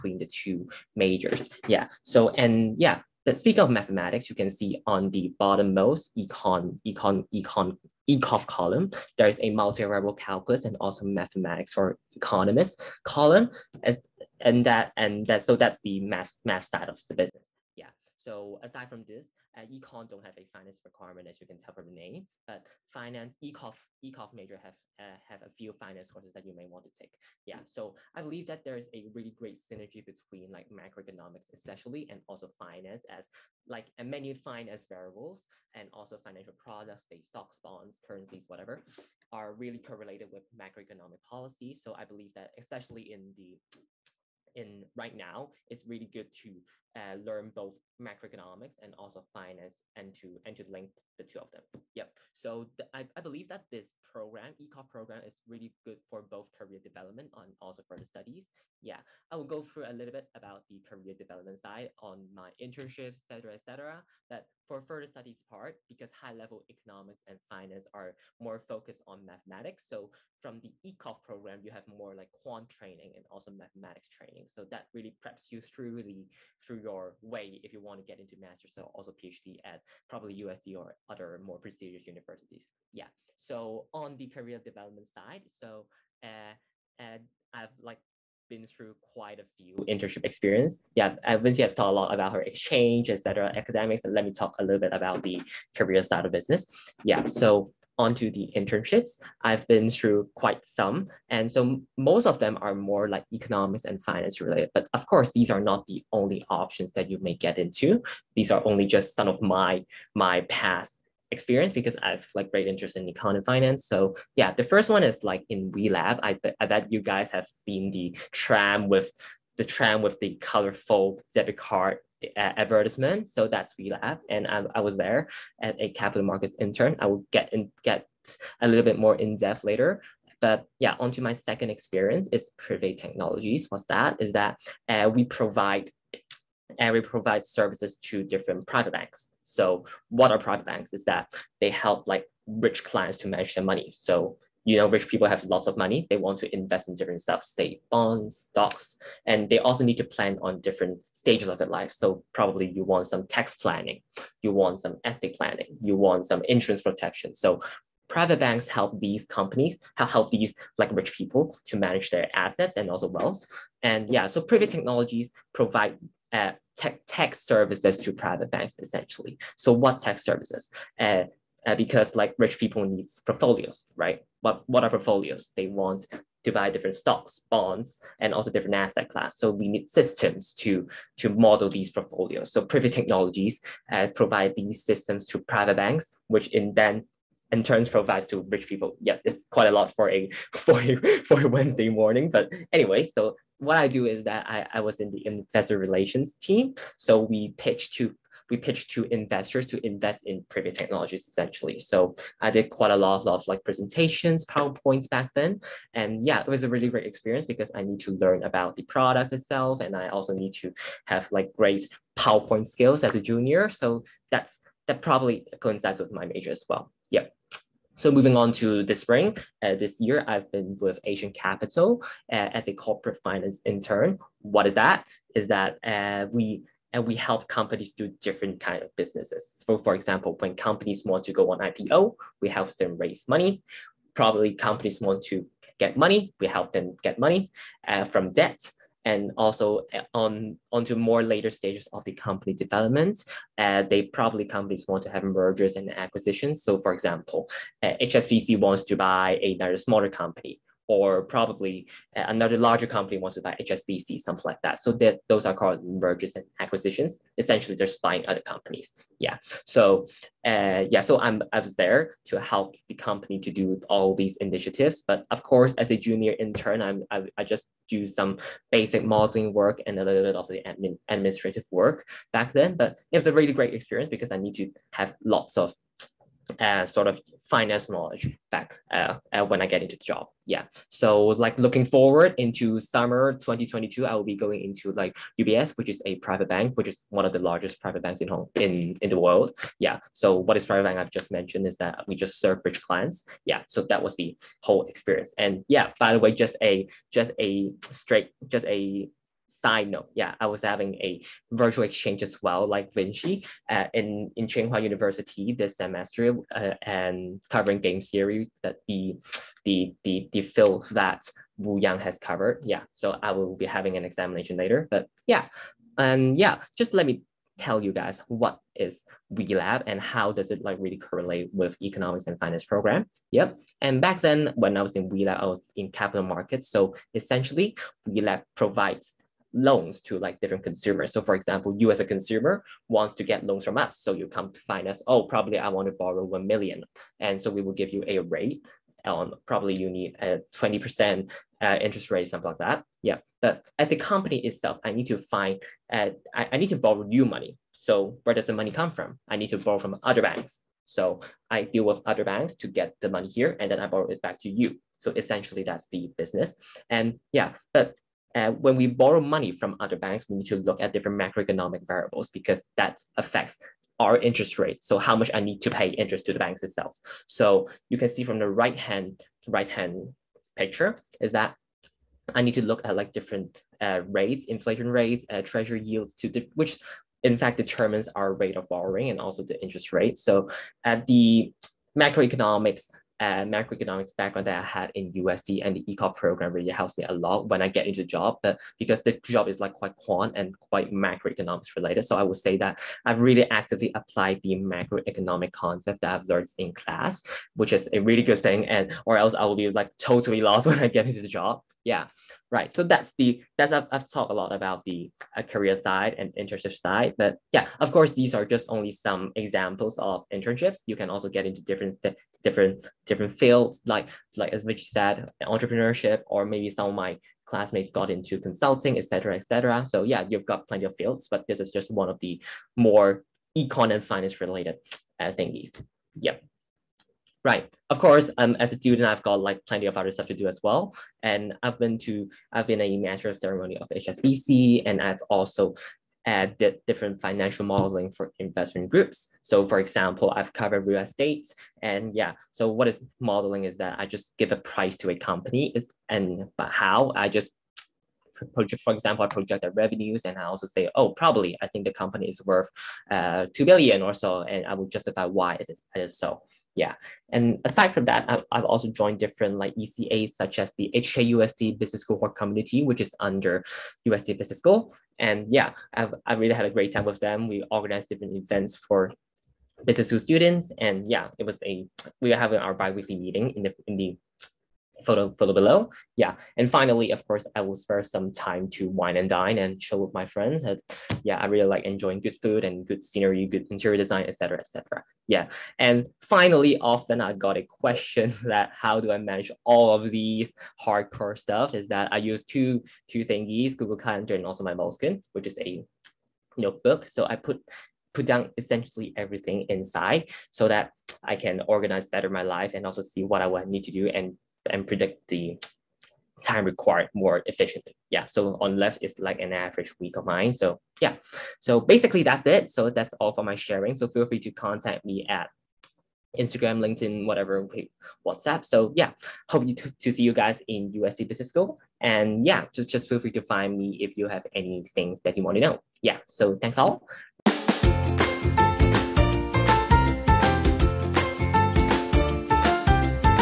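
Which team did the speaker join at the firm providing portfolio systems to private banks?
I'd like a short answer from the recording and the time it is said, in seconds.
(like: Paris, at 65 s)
Investor relations, at 195 s.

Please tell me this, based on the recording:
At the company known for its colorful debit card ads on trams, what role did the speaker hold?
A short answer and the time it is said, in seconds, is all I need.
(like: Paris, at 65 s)
Capital markets intern, at 125 s.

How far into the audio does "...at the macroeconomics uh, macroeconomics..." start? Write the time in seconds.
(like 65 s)
380 s.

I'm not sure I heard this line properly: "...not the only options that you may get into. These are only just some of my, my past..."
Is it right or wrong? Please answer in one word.
right.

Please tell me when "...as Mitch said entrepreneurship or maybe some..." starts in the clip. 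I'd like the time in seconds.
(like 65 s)
414 s.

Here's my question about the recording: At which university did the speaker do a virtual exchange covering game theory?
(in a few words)
Tsinghua University.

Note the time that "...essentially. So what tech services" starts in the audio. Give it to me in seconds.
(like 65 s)
168 s.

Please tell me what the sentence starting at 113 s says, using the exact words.
So yeah, the first one is like in WeLab.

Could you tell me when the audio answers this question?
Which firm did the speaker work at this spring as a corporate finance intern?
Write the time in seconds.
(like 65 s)
221 s.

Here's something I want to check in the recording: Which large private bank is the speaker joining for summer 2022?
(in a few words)
UBS.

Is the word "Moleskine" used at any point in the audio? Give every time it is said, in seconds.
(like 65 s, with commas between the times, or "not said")
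494 s.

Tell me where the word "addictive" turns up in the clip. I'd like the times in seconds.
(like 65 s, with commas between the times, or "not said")
not said.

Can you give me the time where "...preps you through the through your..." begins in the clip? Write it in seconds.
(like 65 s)
75 s.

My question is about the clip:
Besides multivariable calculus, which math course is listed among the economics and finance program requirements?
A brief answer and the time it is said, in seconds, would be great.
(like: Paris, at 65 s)
Mathematics for economists, at 11 s.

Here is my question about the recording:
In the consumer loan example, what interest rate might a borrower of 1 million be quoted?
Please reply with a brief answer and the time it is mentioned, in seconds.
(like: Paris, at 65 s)
20%, at 340 s.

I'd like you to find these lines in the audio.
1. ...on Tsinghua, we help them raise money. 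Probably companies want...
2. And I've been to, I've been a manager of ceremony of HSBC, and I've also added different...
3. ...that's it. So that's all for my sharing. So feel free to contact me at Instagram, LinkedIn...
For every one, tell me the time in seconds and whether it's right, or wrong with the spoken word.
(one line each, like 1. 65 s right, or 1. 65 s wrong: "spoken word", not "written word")
1. 231 s wrong: "IPO", not "Tsinghua"
2. 431 s right
3. 512 s right.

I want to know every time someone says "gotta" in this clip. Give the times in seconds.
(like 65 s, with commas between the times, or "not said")
not said.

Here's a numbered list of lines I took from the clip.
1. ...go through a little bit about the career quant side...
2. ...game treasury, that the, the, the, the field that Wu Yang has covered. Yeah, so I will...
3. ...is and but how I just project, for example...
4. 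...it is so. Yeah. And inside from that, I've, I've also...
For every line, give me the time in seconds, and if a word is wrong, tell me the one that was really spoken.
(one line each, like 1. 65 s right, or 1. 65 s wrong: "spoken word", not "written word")
1. 59 s wrong: "development", not "quant"
2. 307 s wrong: "theory", not "treasury"
3. 445 s right
4. 455 s wrong: "aside", not "inside".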